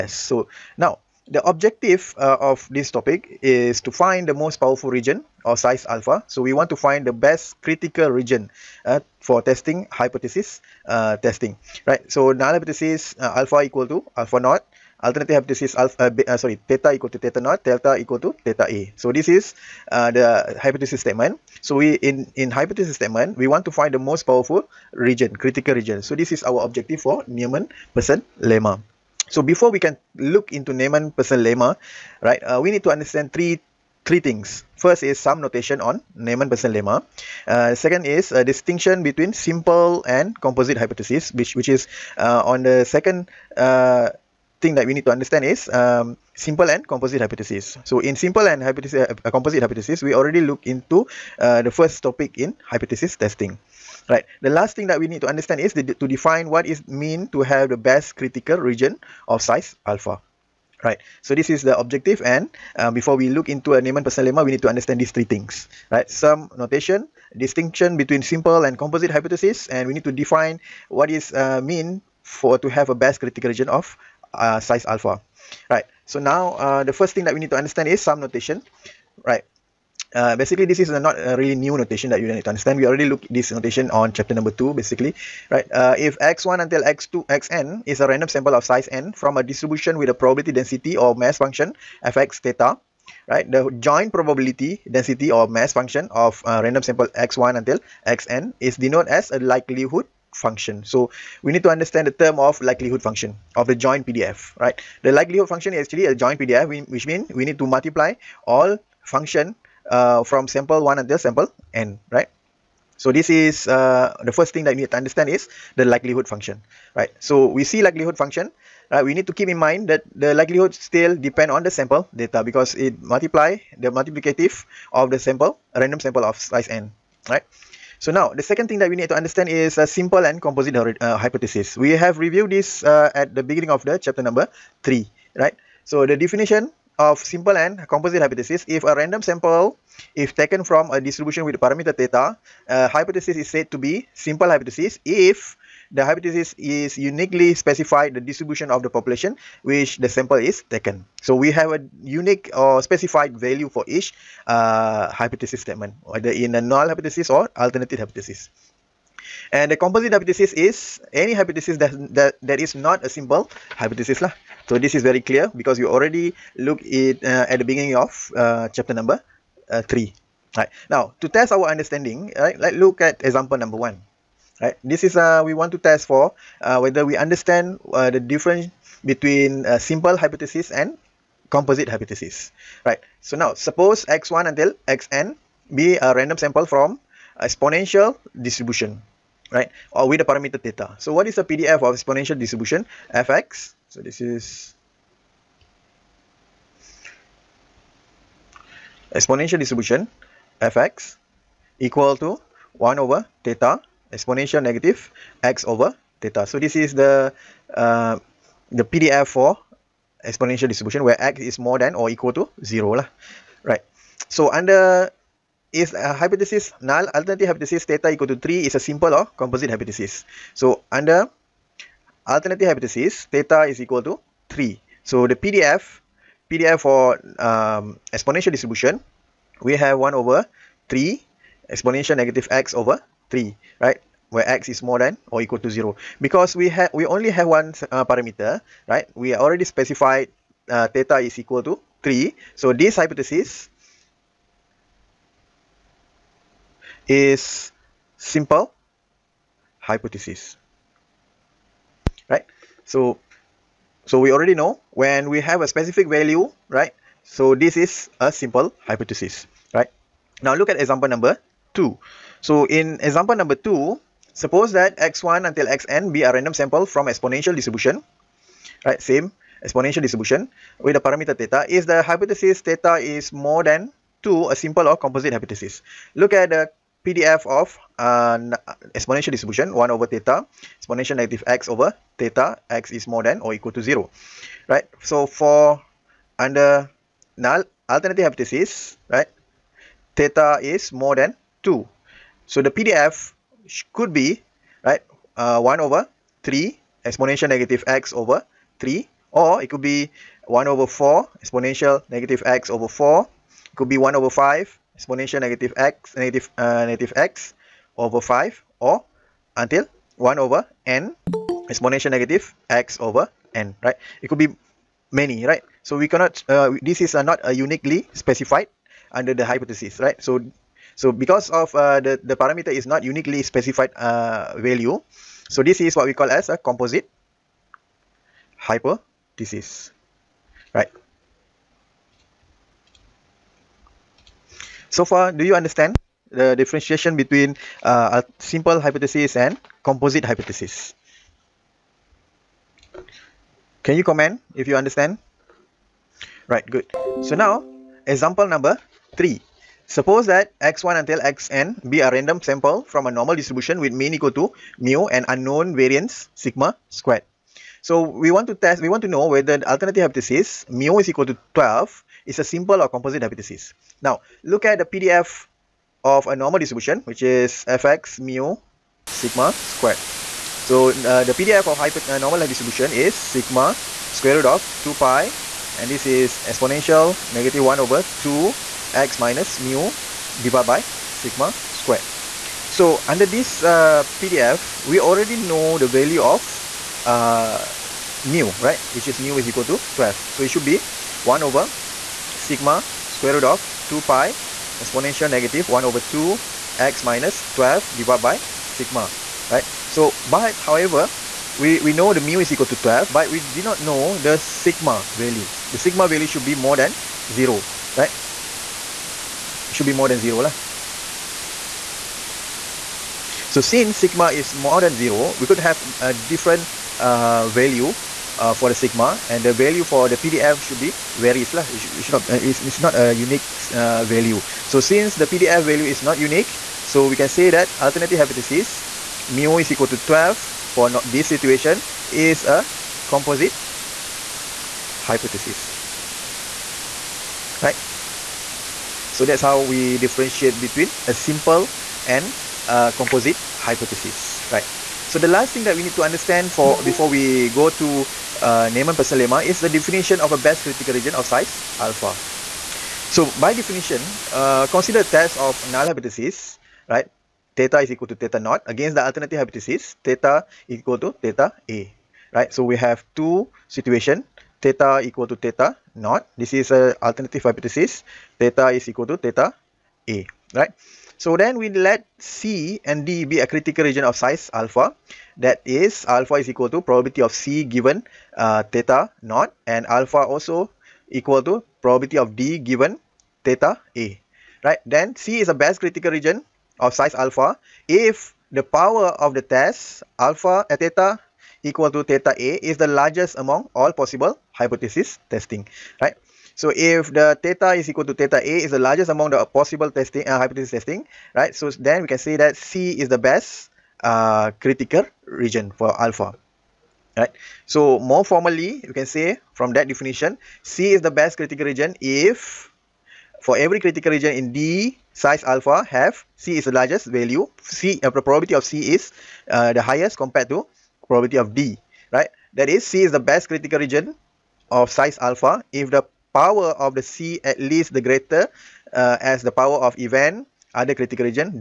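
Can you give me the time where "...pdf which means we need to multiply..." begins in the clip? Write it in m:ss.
1:46.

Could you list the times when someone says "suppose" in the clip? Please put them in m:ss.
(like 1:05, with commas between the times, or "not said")
3:03, 4:24, 5:49.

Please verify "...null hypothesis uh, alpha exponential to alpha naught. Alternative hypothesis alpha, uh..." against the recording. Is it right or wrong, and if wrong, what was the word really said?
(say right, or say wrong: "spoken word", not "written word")
wrong: "equal", not "exponential".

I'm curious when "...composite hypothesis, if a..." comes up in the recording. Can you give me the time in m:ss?
2:17.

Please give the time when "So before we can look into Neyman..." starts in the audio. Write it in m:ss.
0:29.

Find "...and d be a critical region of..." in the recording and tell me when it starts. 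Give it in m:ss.
7:52.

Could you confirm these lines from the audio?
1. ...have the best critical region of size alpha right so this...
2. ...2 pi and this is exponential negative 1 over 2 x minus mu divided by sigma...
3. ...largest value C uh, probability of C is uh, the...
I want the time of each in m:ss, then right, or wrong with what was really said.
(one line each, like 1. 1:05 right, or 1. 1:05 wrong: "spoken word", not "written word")
1. 0:57 right
2. 6:14 right
3. 8:36 right.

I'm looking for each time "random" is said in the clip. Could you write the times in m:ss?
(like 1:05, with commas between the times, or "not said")
1:28, 1:36, 2:05, 2:18, 3:06, 4:26, 5:52.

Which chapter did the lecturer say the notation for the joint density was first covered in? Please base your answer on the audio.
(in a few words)
chapter 2.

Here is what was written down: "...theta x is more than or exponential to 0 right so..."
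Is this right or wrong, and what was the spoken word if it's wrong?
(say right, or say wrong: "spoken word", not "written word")
wrong: "equal", not "exponential".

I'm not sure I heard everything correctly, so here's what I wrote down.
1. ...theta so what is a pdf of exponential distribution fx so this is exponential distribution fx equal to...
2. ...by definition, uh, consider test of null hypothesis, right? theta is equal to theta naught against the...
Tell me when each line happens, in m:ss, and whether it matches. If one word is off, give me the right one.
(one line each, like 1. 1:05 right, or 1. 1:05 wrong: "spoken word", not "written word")
1. 3:10 right
2. 7:33 right.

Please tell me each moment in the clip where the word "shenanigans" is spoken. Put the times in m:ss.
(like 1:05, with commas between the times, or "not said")
not said.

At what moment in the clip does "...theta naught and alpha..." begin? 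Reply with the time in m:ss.
7:58.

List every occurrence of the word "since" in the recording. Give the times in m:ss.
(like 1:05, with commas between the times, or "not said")
6:53, 7:04.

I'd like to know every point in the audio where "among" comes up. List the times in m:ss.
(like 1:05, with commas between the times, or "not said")
8:13, 8:19.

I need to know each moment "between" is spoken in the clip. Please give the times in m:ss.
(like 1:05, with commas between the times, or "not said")
0:39, 1:07, 2:59, 5:37, 7:20.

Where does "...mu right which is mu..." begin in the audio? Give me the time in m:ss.
6:28.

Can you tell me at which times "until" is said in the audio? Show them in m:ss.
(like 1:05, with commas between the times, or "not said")
1:26, 1:37, 1:50, 3:04, 4:25, 5:09, 5:50.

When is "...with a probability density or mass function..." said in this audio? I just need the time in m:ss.
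1:30.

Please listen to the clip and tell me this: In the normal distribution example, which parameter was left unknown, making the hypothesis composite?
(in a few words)
variance sigma squared.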